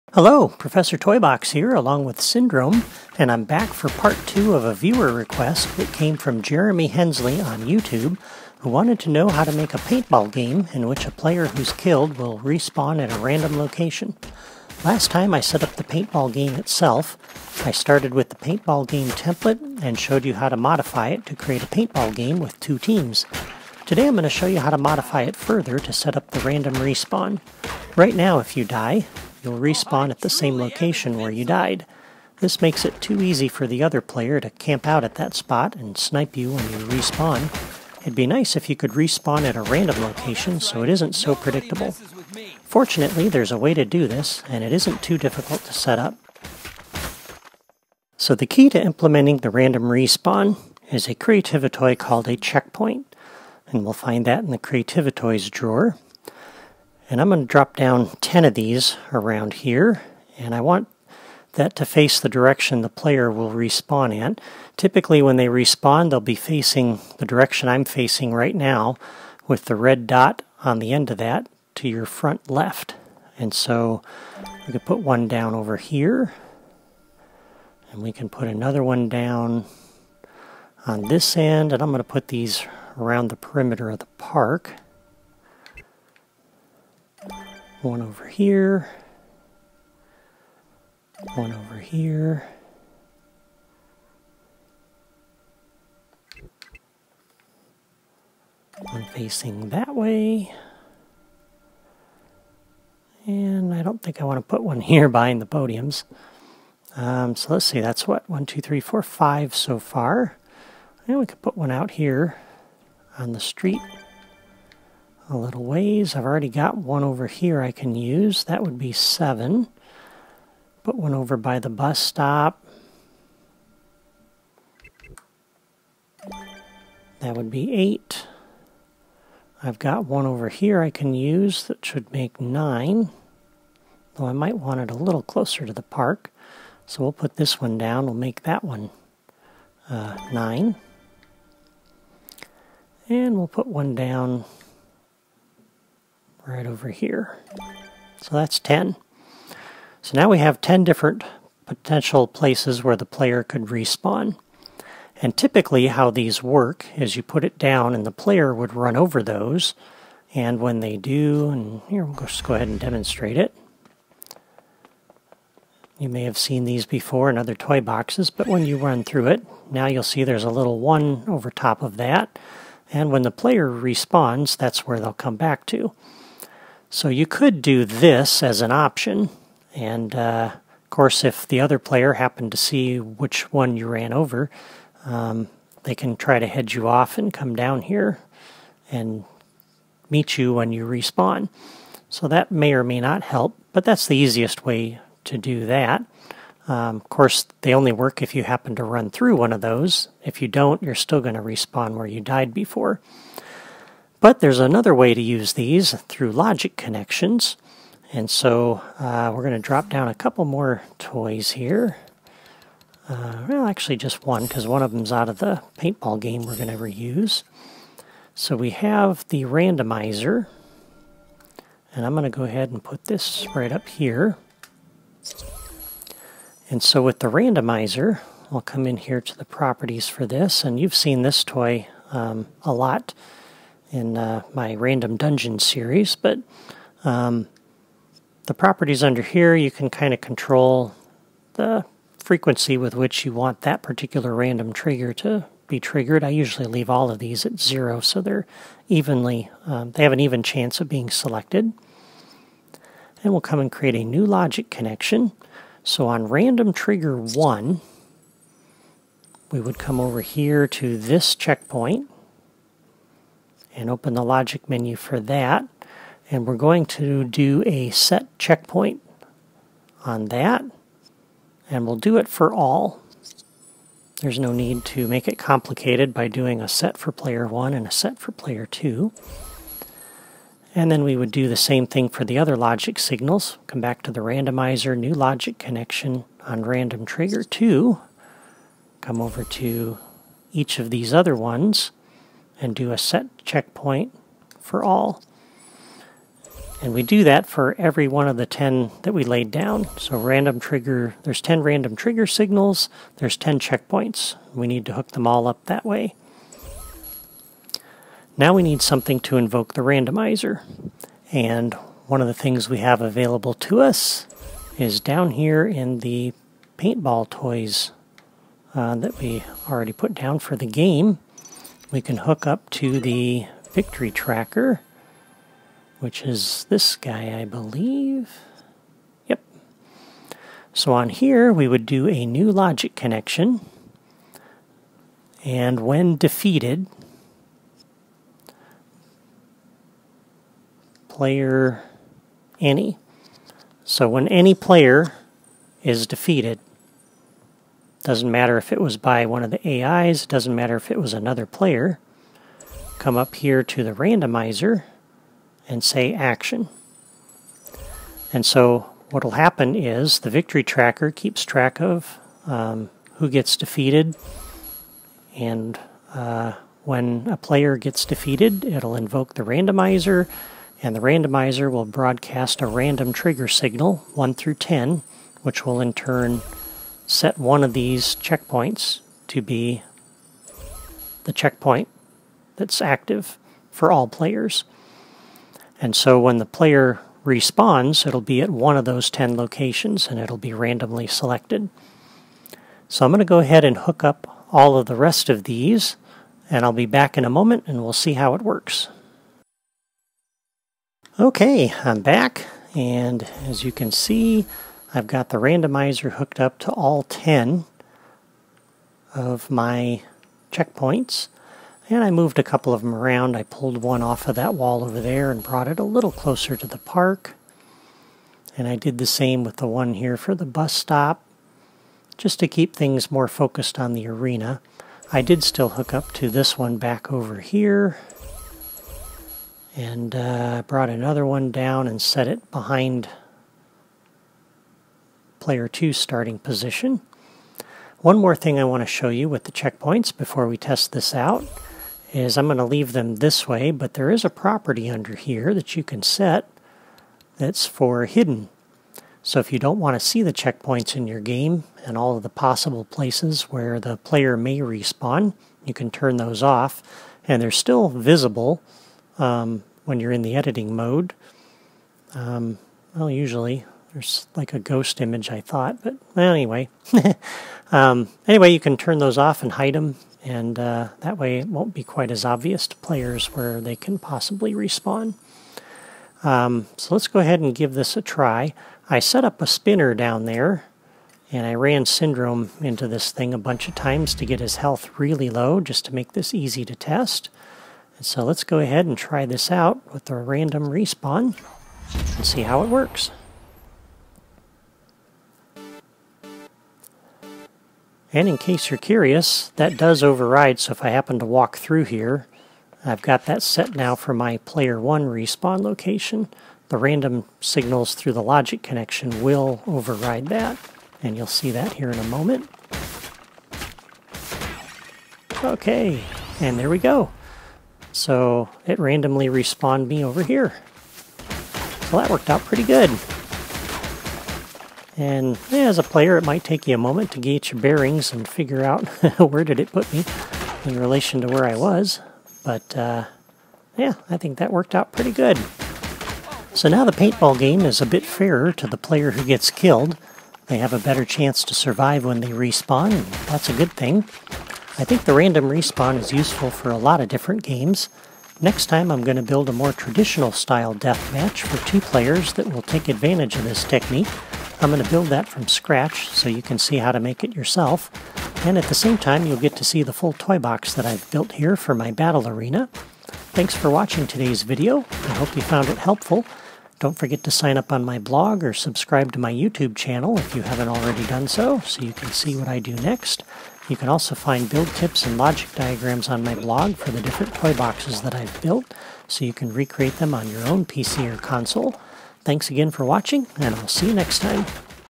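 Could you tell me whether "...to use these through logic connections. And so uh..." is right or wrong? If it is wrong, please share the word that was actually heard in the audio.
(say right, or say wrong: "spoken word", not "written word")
right.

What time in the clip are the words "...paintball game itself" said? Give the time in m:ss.
0:15.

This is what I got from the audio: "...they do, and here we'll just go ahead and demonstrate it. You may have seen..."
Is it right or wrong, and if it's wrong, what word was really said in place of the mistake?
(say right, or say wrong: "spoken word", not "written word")
right.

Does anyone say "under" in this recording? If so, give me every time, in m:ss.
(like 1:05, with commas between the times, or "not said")
3:59, 7:24.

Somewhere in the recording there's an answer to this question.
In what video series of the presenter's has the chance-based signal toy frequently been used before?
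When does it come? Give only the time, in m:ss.
3:54.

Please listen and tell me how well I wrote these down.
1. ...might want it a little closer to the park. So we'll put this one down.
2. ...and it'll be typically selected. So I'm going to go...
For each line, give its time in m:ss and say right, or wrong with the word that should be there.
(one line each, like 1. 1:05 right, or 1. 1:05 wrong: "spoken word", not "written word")
1. 2:14 right
2. 6:30 wrong: "randomly", not "typically".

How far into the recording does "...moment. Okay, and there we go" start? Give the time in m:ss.
8:32.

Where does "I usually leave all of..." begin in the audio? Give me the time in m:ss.
4:06.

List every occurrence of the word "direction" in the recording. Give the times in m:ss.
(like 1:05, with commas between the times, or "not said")
1:02, 1:07.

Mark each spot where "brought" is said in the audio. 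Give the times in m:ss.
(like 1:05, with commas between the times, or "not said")
6:55, 7:10.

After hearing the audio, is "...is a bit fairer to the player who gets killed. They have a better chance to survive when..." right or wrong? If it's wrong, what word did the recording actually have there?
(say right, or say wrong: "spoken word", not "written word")
right.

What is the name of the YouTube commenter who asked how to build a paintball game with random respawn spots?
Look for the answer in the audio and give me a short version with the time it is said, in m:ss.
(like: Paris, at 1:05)
Jeremy Hensley, at 0:06.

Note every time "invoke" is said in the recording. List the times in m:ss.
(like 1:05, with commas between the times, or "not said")
5:09, 6:08.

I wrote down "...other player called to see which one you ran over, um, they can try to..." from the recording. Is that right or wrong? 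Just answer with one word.
wrong.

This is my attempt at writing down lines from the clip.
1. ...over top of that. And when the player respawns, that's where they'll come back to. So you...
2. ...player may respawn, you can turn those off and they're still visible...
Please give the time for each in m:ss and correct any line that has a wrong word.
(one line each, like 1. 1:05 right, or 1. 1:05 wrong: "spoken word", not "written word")
1. 2:51 right
2. 7:33 right.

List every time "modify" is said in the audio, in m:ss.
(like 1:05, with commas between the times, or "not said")
0:20, 0:24.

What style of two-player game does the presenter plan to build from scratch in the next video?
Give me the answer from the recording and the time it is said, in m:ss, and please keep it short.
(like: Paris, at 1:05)
deathmatch, at 9:10.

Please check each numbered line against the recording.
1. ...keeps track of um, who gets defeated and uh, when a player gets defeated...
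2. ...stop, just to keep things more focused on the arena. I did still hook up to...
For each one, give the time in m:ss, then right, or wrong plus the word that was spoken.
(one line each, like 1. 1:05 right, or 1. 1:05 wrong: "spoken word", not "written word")
1. 6:01 right
2. 7:00 right.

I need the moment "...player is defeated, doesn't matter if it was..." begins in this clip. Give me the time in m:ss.
5:44.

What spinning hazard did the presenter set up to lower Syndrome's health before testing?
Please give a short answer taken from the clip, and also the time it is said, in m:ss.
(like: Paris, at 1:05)
spinner, at 7:59.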